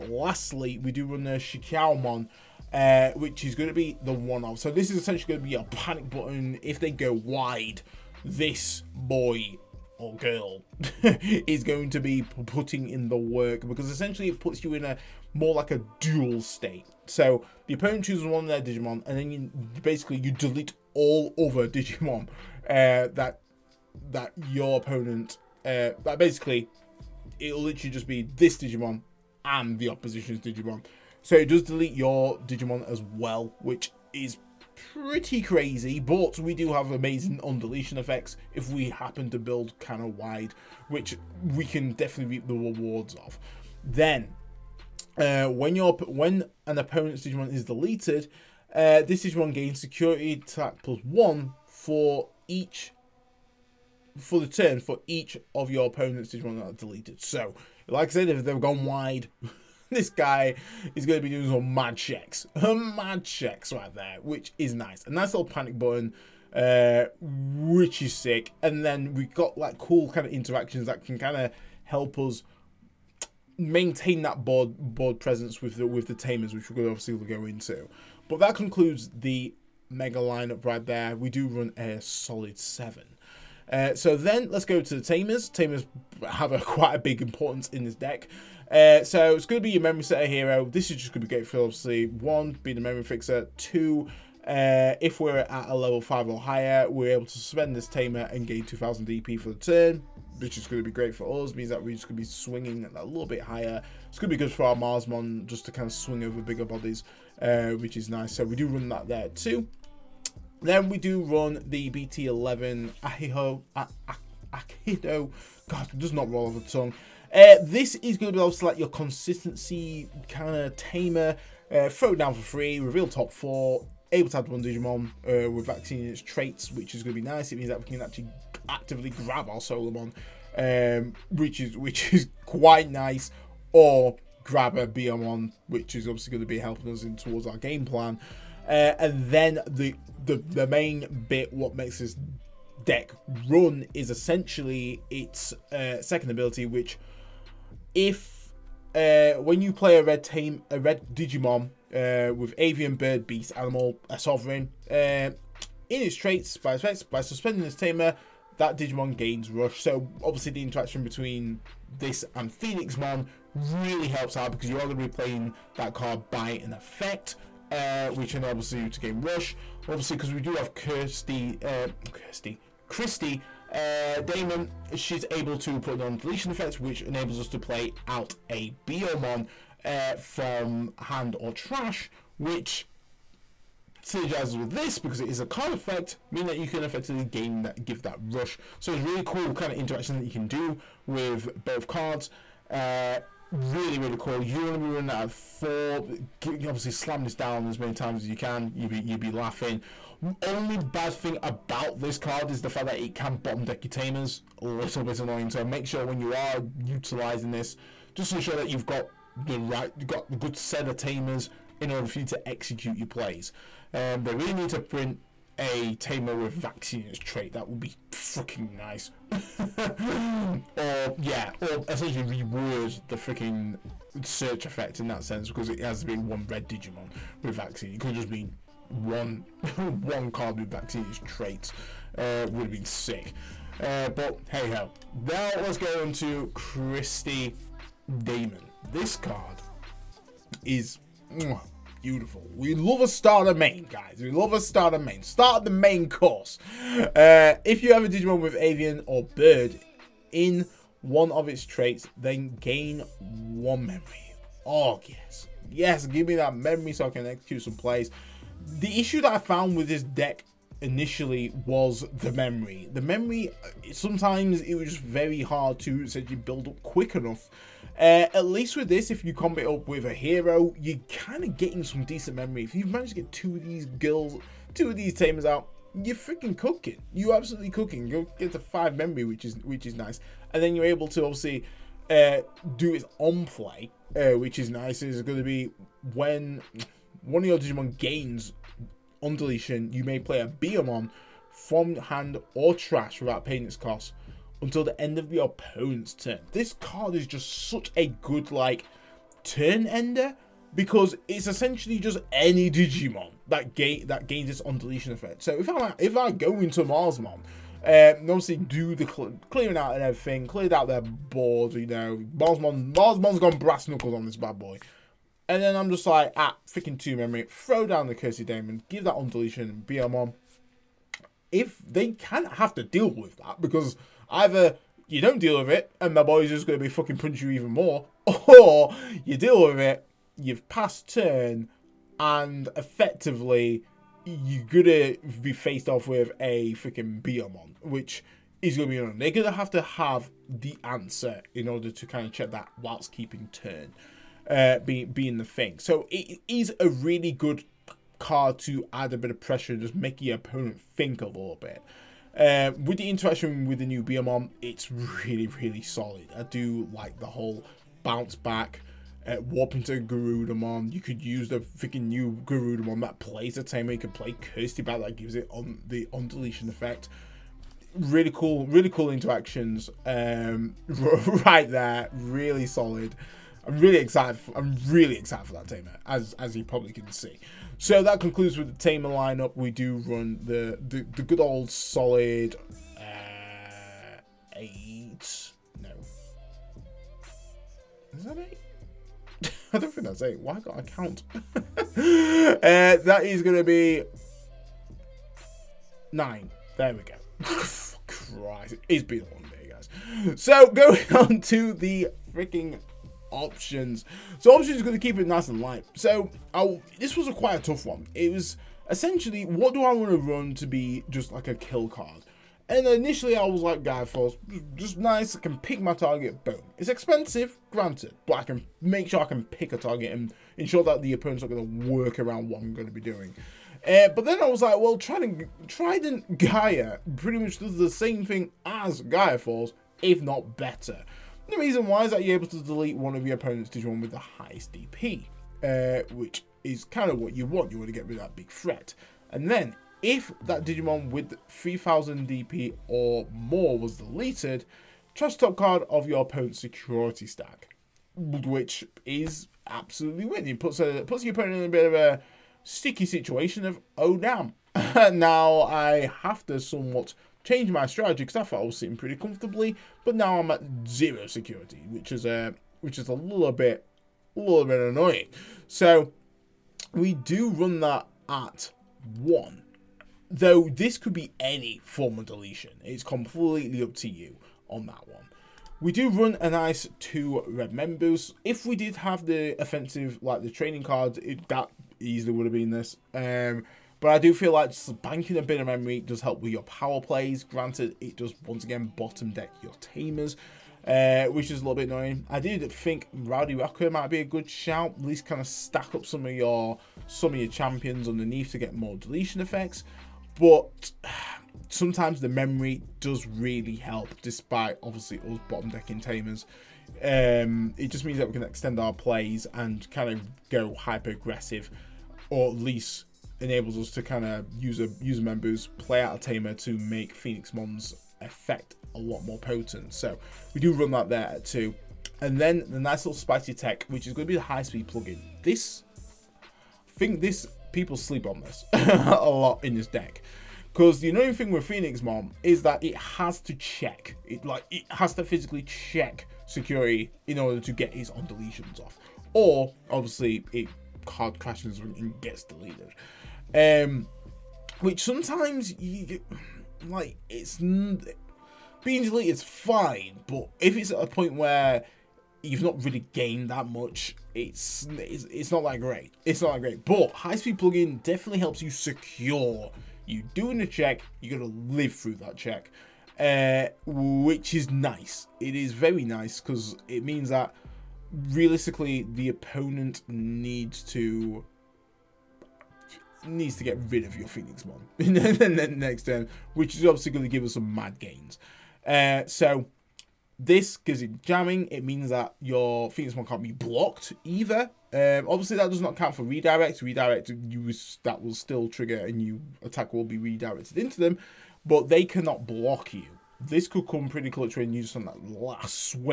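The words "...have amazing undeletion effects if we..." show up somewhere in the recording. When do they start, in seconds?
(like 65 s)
36 s.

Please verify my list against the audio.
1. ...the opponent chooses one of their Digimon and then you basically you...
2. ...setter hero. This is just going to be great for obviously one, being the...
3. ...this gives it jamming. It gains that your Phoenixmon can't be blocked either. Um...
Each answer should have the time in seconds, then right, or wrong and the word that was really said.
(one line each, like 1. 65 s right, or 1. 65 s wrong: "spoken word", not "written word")
1. 17 s right
2. 90 s right
3. 580 s wrong: "means", not "gains".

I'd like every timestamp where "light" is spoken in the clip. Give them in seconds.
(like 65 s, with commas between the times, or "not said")
405 s.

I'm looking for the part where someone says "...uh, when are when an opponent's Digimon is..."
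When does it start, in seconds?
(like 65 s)
45 s.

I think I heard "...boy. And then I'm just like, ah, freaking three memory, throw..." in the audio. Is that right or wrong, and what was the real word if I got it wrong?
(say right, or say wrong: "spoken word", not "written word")
wrong: "two", not "three".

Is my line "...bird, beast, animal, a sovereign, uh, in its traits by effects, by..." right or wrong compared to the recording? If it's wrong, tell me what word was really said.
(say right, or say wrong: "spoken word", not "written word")
right.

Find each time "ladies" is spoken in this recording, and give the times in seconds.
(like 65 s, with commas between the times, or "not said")
not said.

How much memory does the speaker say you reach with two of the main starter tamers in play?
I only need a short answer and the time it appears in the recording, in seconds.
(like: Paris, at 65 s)
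5, at 278 s.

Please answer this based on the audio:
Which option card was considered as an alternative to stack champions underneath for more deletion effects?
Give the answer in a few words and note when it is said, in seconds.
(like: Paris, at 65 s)
Rowdy Rocker, at 493 s.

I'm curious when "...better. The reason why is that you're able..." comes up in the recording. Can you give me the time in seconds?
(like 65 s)
430 s.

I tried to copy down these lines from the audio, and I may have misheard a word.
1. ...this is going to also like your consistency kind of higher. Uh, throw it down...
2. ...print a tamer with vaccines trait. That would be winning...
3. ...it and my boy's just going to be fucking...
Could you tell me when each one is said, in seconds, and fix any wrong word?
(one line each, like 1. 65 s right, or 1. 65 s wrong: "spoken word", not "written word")
1. 117 s wrong: "tamer", not "higher"
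2. 214 s wrong: "fucking", not "winning"
3. 325 s right.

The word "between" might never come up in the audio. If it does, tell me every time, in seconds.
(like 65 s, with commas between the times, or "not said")
161 s.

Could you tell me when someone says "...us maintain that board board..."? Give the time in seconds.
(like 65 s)
72 s.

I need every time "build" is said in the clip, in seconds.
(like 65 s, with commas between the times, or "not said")
39 s, 266 s.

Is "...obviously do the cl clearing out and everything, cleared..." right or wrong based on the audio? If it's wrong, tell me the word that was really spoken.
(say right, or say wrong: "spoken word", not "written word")
right.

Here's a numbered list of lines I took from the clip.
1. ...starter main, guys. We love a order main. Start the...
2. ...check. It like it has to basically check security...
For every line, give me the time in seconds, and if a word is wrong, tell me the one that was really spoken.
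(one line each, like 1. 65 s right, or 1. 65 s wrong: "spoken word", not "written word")
1. 243 s wrong: "starter", not "order"
2. 533 s wrong: "physically", not "basically".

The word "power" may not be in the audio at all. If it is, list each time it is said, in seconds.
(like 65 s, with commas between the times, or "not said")
486 s.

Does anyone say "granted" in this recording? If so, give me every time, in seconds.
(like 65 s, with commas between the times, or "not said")
417 s, 487 s.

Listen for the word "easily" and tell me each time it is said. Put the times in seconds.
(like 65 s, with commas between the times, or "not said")
481 s.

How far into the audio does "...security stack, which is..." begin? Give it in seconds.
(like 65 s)
446 s.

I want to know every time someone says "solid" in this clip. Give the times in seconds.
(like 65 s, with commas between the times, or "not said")
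81 s, 355 s, 372 s, 381 s.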